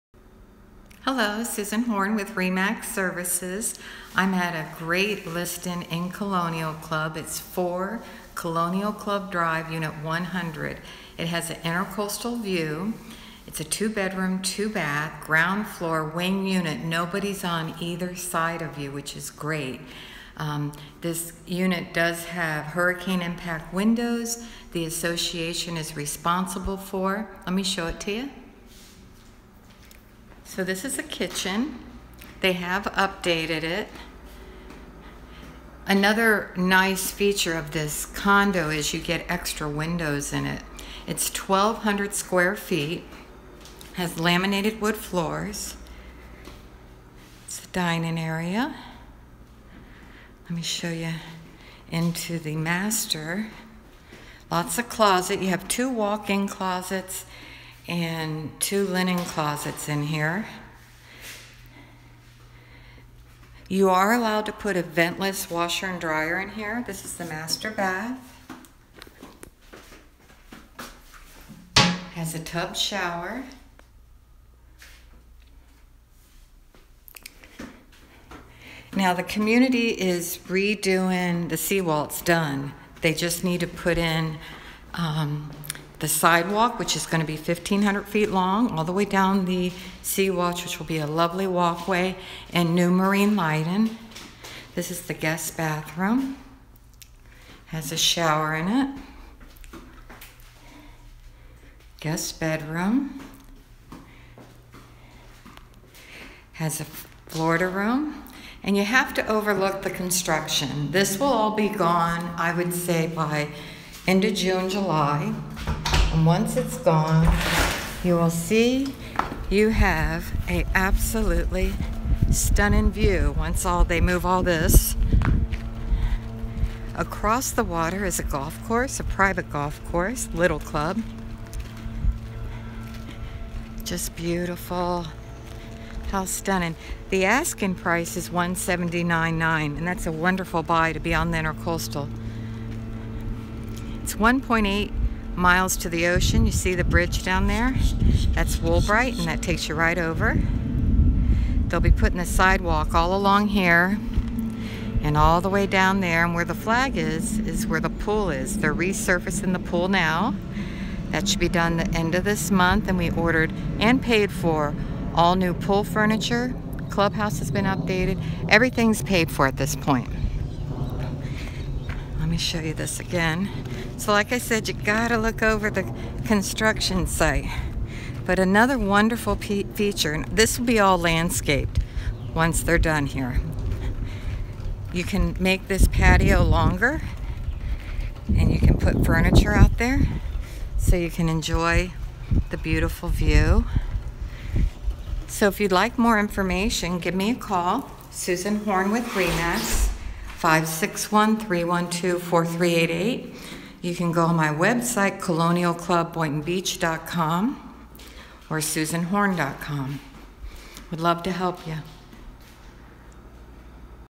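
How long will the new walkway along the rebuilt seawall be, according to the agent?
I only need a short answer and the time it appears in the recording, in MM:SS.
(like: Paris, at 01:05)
1,500 feet, at 01:27.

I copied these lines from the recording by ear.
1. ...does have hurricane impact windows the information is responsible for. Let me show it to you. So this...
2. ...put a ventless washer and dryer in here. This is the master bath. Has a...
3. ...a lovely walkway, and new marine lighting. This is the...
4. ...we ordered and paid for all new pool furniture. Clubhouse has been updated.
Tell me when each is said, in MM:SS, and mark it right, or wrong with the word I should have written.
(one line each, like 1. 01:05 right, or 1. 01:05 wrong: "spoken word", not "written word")
1. 00:21 wrong: "association", not "information"
2. 01:04 right
3. 01:30 right
4. 02:42 right.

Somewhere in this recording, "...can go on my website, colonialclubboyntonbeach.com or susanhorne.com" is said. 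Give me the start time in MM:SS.
03:23.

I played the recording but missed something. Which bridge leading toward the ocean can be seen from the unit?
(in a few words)
Woolbright.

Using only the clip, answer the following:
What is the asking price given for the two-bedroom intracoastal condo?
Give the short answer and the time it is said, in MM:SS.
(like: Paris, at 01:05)
179.9, at 02:18.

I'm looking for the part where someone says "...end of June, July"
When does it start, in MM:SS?
01:54.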